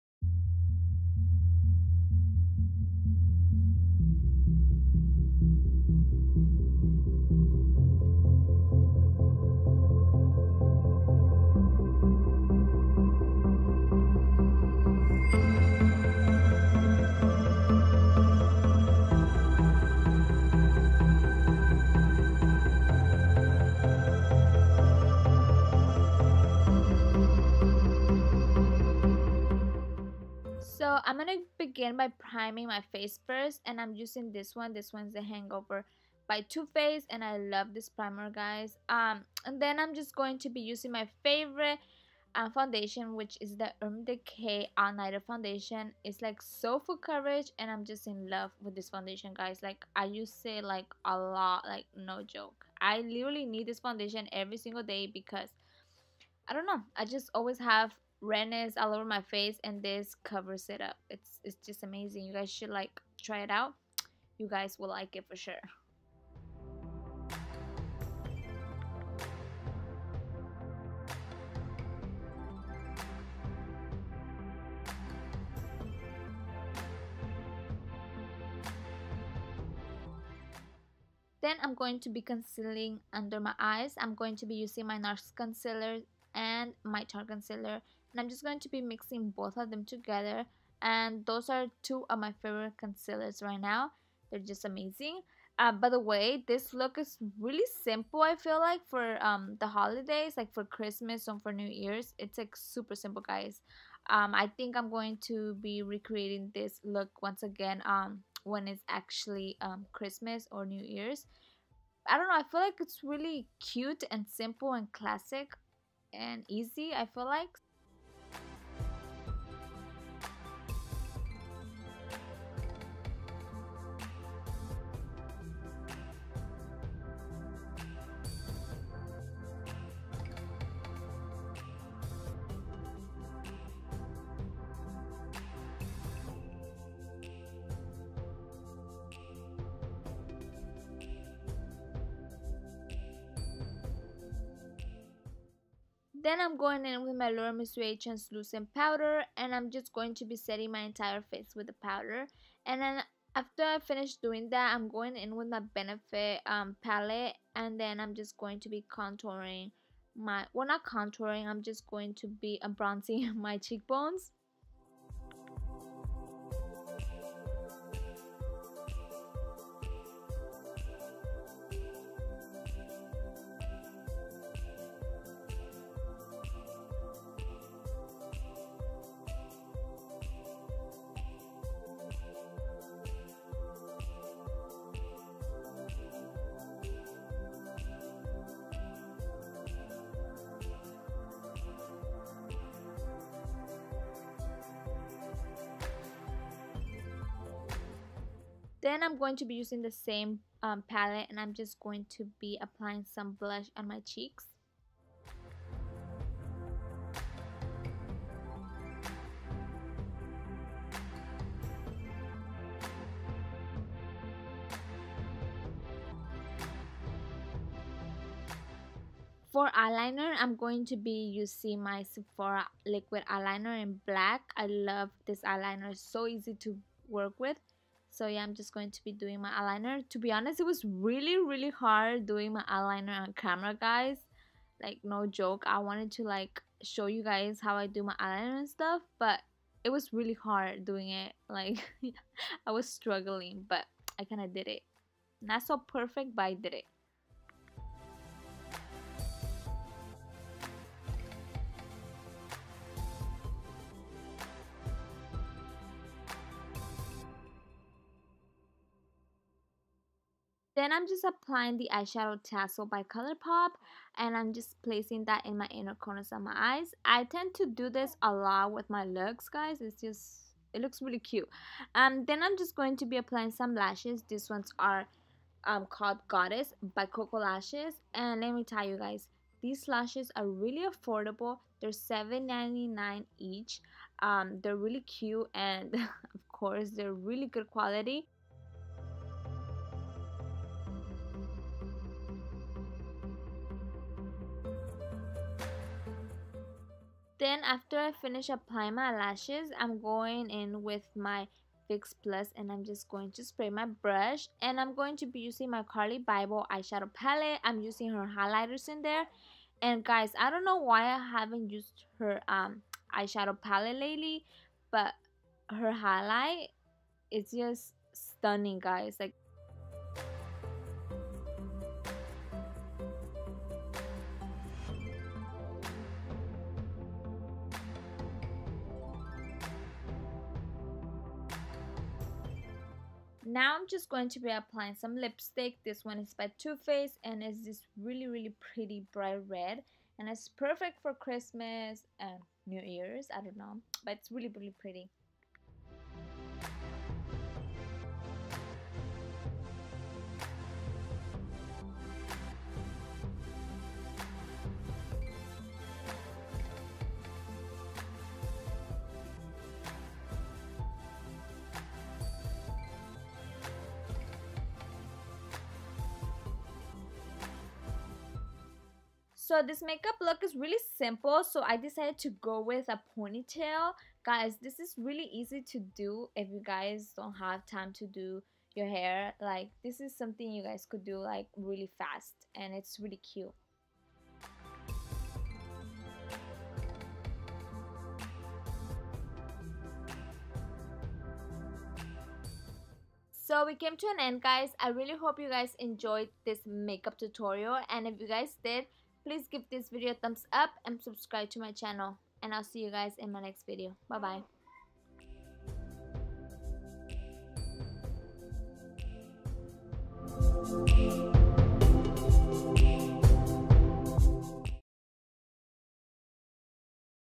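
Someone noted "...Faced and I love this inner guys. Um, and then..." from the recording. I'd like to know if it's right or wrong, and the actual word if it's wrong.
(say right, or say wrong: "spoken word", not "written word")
wrong: "primer", not "inner".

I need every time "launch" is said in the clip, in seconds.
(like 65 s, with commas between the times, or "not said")
not said.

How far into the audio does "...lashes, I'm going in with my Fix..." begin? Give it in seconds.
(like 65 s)
299 s.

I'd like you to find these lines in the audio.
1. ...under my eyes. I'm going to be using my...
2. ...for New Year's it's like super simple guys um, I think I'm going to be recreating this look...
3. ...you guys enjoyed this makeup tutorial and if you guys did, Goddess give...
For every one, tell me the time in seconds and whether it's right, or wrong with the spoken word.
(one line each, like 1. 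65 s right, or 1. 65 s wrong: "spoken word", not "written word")
1. 83 s right
2. 101 s right
3. 395 s wrong: "Please", not "Goddess".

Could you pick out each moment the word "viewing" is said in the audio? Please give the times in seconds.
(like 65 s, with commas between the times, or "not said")
not said.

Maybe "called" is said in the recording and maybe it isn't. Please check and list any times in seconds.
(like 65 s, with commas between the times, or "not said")
275 s.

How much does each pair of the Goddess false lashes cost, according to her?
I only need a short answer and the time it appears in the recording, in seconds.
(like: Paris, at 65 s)
$7.99, at 281 s.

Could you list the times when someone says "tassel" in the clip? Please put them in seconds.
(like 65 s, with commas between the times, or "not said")
262 s.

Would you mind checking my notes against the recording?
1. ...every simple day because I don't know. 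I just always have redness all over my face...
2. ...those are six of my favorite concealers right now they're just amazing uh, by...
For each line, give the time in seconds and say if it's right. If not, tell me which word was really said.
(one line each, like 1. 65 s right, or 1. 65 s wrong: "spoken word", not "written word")
1. 54 s wrong: "single", not "simple"
2. 91 s wrong: "two", not "six".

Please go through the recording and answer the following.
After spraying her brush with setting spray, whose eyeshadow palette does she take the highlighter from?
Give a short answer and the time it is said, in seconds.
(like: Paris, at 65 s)
Carli Bybel, at 305 s.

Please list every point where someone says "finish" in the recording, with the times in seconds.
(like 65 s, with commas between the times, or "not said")
153 s, 298 s.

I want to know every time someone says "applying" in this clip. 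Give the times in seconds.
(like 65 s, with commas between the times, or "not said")
202 s, 261 s, 273 s, 298 s, 334 s.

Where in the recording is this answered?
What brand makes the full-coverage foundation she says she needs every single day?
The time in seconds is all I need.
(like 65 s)
43 s.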